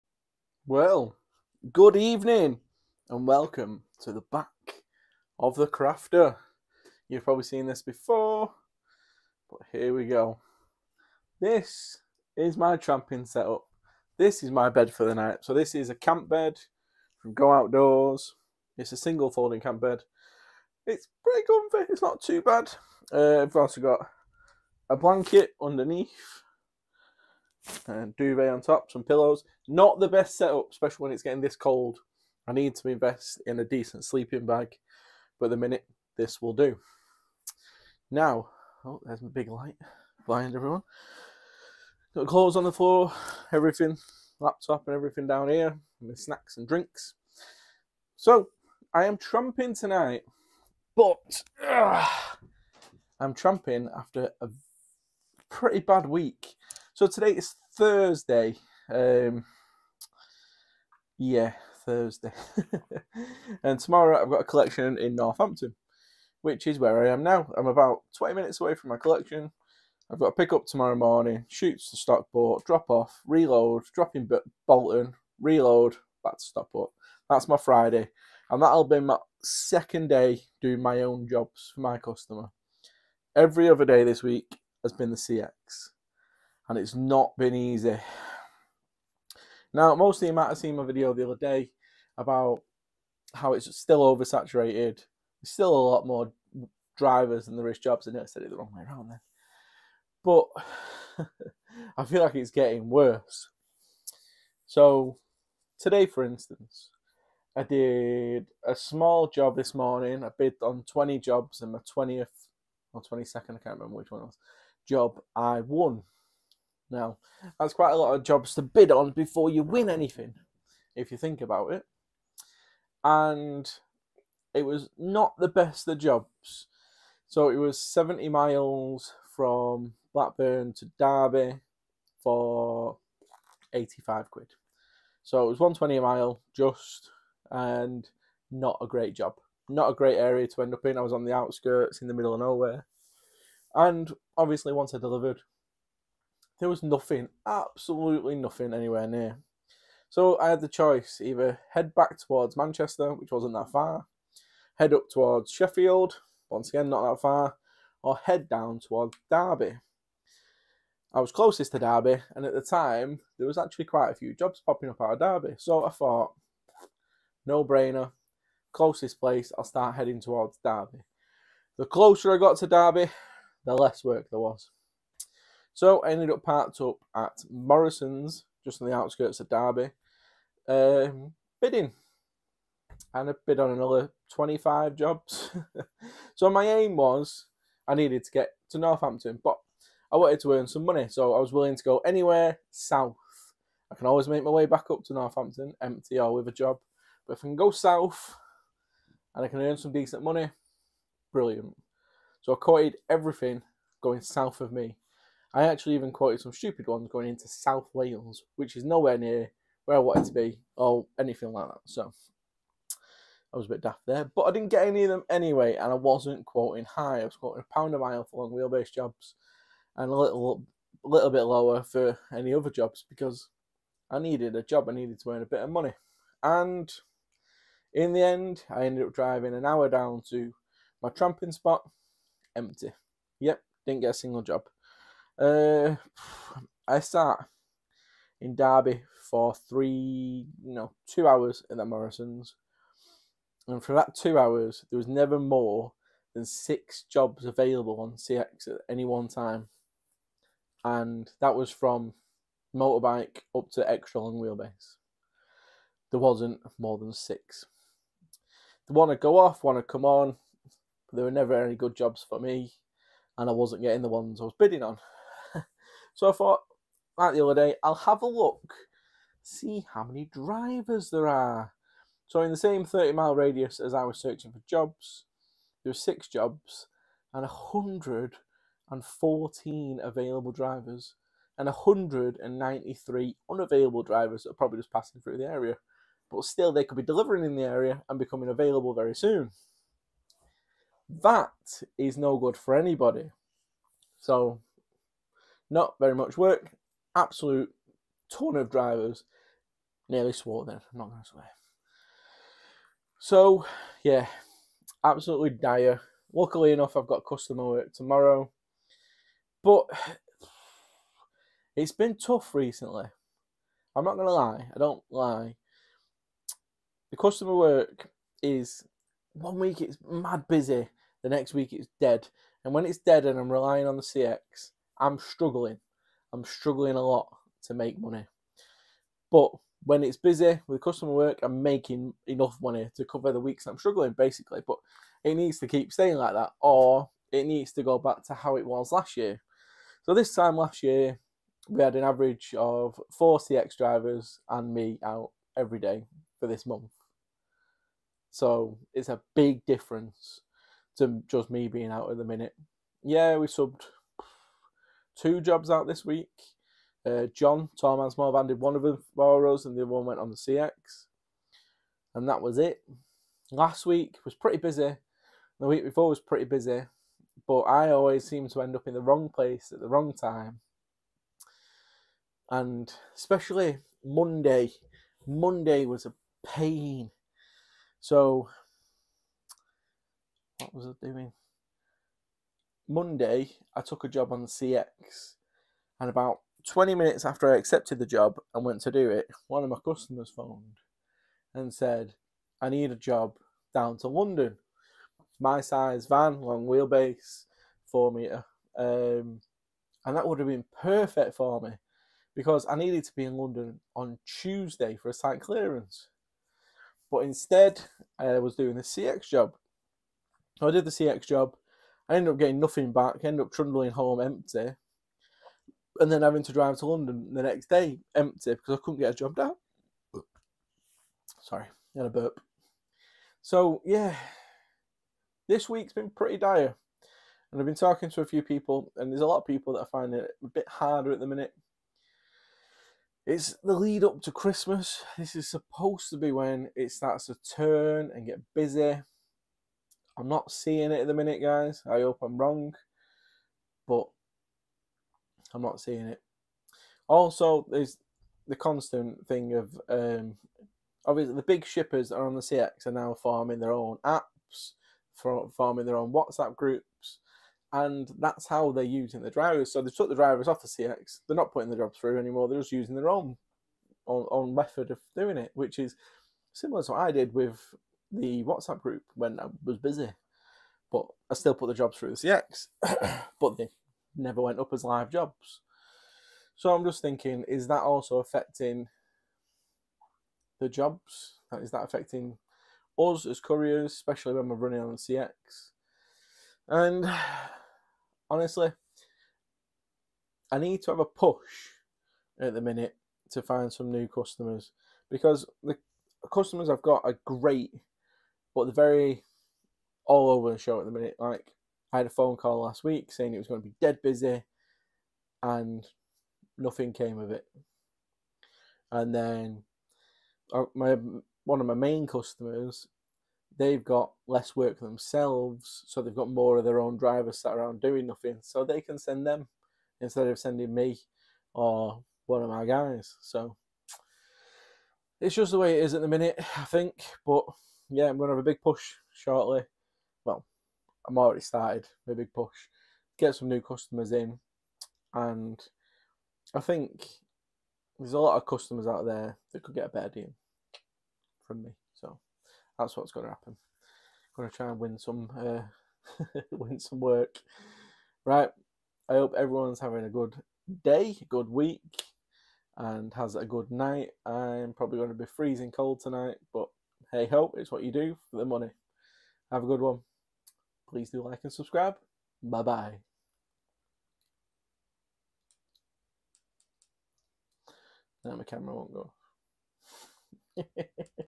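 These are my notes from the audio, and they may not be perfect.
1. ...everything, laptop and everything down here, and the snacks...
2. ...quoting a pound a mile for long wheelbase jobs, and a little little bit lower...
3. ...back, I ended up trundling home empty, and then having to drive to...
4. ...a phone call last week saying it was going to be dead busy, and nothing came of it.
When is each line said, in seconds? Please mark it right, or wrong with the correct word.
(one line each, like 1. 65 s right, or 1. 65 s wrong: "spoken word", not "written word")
1. 43 s right
2. 217 s right
3. 412 s right
4. 502 s right.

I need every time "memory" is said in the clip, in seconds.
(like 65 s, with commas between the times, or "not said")
not said.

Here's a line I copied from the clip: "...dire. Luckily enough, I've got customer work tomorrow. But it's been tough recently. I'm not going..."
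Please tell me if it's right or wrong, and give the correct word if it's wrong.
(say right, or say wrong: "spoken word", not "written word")
right.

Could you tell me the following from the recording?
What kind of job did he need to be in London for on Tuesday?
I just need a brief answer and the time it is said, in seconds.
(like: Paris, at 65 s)
Site clearance, at 405 s.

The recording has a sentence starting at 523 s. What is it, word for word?
So it's just the way it is at the minute, I think.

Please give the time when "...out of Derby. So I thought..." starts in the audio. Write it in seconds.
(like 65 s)
165 s.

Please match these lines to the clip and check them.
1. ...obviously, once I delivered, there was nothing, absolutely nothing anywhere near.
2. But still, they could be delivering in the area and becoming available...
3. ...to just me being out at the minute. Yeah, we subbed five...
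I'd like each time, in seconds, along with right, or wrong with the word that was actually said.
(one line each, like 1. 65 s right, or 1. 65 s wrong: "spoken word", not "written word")
1. 144 s right
2. 286 s right
3. 350 s wrong: "two", not "five".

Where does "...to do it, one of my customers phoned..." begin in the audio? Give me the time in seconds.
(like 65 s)
388 s.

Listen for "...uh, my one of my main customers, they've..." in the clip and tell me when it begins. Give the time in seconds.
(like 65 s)
510 s.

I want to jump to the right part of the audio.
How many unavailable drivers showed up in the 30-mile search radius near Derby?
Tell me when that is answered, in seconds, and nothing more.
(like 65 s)
281 s.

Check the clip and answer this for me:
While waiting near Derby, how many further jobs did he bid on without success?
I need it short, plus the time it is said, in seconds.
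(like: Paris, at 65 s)
25, at 184 s.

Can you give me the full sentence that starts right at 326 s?
I'm struggling a lot to make money.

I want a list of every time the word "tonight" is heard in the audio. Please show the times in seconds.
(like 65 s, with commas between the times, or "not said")
49 s, 555 s.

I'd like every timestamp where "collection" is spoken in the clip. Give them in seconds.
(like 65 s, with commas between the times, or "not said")
64 s, 68 s.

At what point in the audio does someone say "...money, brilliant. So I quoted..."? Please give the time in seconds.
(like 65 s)
200 s.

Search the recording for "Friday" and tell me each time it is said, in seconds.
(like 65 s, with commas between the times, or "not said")
77 s.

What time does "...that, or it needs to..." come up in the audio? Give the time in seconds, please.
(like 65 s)
336 s.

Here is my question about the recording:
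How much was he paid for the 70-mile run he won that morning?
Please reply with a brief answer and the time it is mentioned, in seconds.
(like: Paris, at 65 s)
85 pounds, at 133 s.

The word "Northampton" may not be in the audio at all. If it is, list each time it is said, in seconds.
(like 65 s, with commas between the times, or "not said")
65 s, 188 s, 195 s.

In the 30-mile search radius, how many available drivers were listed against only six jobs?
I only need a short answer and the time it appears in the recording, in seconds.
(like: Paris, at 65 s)
114, at 277 s.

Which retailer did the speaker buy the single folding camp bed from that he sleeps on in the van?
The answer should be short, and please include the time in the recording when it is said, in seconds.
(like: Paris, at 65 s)
Go Outdoors, at 17 s.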